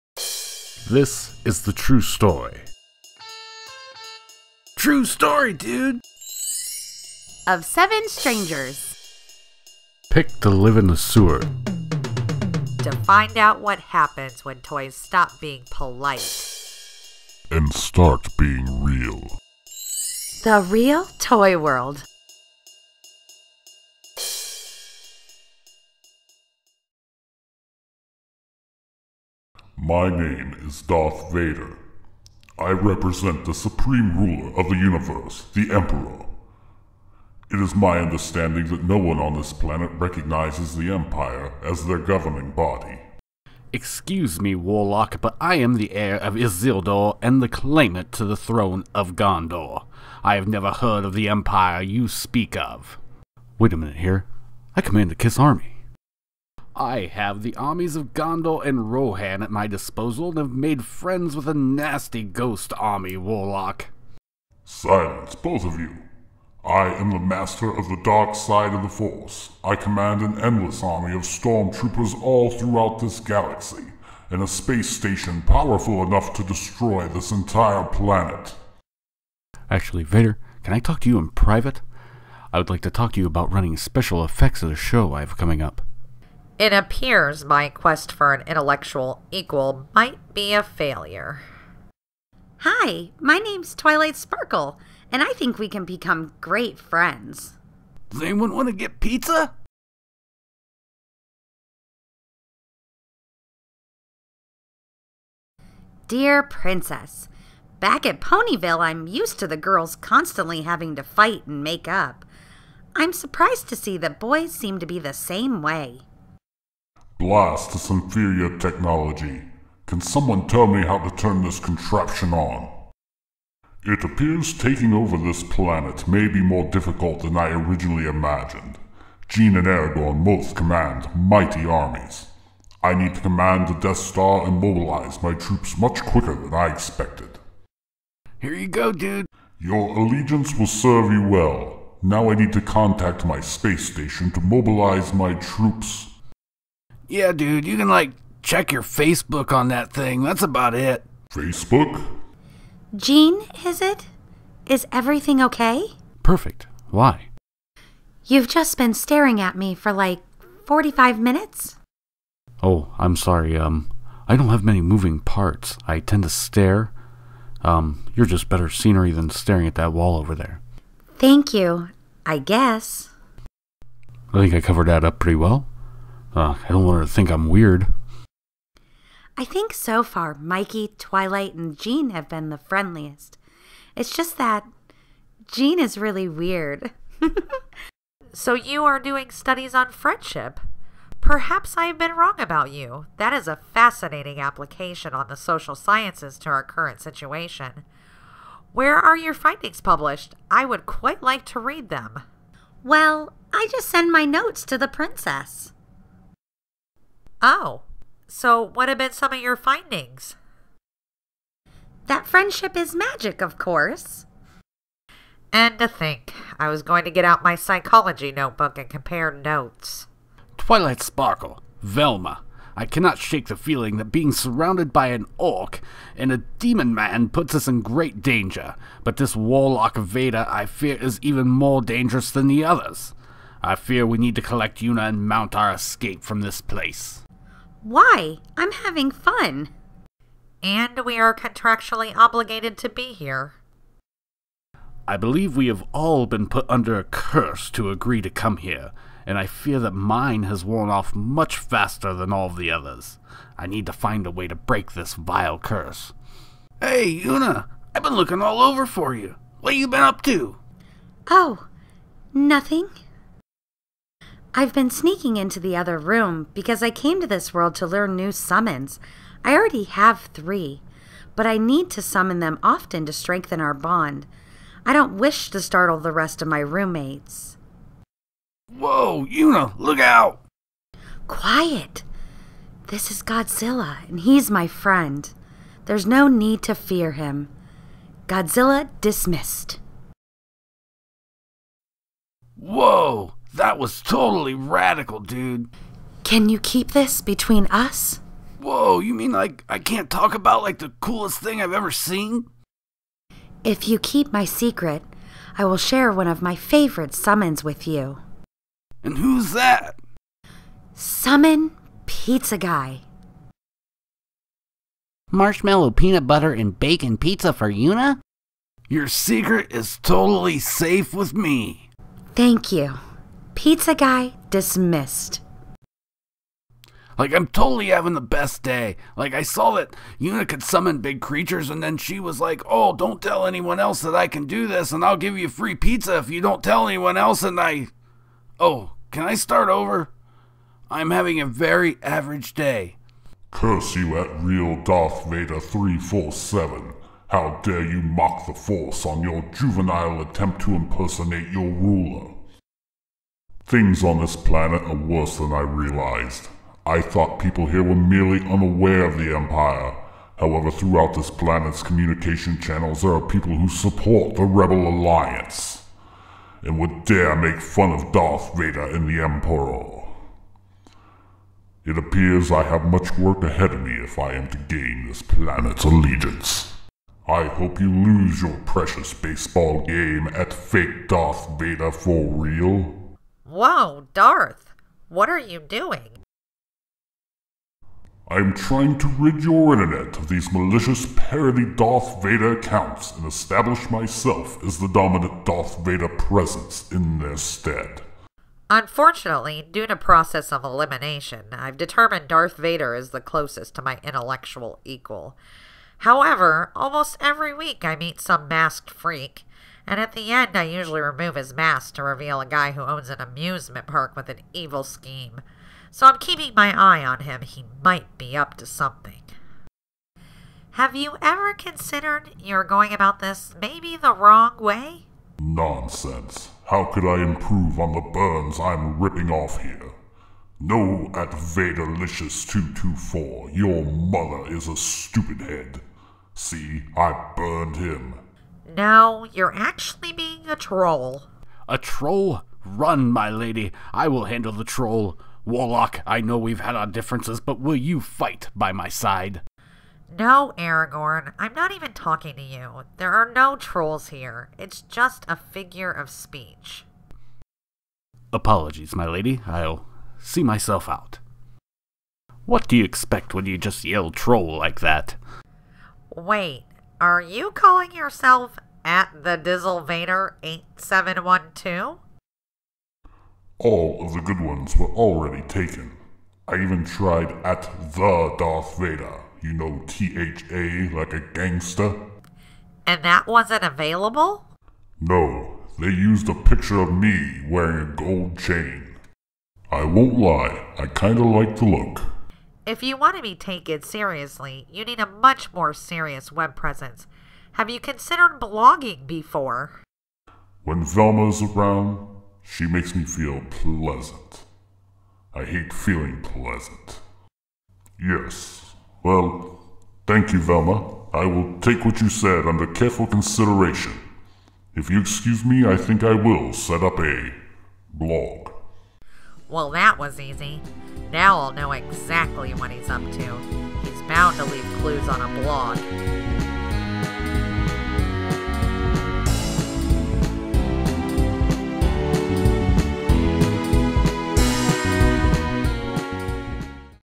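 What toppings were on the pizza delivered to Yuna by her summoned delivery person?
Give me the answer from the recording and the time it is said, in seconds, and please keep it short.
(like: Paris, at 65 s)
Marshmallow peanut butter and bacon, at 315 s.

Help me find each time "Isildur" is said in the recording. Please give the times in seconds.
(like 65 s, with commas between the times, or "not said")
46 s.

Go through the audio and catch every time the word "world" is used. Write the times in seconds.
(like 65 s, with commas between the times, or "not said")
21 s, 267 s.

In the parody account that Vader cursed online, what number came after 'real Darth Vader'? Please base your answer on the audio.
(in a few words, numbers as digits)
347.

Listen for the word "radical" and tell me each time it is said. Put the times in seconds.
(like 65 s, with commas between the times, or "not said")
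294 s.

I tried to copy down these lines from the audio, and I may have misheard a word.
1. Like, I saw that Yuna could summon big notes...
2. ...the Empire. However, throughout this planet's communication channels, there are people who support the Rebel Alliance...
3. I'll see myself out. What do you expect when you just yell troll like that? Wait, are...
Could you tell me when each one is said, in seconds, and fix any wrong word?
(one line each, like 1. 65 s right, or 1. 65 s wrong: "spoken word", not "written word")
1. 329 s wrong: "creatures", not "notes"
2. 359 s right
3. 459 s right.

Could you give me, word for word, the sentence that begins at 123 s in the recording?
It appears taking over this planet may be more difficult than I originally imagined.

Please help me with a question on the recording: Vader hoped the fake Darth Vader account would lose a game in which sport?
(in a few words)
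baseball.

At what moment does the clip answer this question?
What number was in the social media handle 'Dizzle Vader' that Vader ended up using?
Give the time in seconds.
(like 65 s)
470 s.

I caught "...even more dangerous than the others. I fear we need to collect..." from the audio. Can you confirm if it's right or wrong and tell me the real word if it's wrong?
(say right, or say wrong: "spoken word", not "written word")
right.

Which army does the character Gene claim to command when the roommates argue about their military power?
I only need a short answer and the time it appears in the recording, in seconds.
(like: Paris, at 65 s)
Kiss Army, at 55 s.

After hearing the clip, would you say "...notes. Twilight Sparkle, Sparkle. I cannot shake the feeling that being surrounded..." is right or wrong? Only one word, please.
wrong.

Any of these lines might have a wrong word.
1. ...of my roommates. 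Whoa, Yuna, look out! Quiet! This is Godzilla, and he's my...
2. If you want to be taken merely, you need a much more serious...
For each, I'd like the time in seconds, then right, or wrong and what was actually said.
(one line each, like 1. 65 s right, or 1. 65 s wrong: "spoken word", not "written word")
1. 276 s right
2. 492 s wrong: "seriously", not "merely".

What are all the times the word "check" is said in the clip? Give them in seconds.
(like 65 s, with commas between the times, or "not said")
148 s.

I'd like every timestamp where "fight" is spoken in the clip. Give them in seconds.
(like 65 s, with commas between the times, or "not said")
111 s, 447 s.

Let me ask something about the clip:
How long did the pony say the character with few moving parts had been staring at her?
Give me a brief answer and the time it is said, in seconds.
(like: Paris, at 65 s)
45 minutes, at 160 s.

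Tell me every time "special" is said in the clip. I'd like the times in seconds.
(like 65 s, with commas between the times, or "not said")
83 s.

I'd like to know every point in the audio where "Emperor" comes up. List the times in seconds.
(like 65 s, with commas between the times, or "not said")
35 s, 369 s.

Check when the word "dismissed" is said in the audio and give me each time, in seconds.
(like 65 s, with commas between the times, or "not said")
288 s, 324 s.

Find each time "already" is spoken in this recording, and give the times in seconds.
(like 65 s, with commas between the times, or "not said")
269 s, 474 s.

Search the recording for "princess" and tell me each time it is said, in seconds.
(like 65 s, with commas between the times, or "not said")
106 s, 204 s.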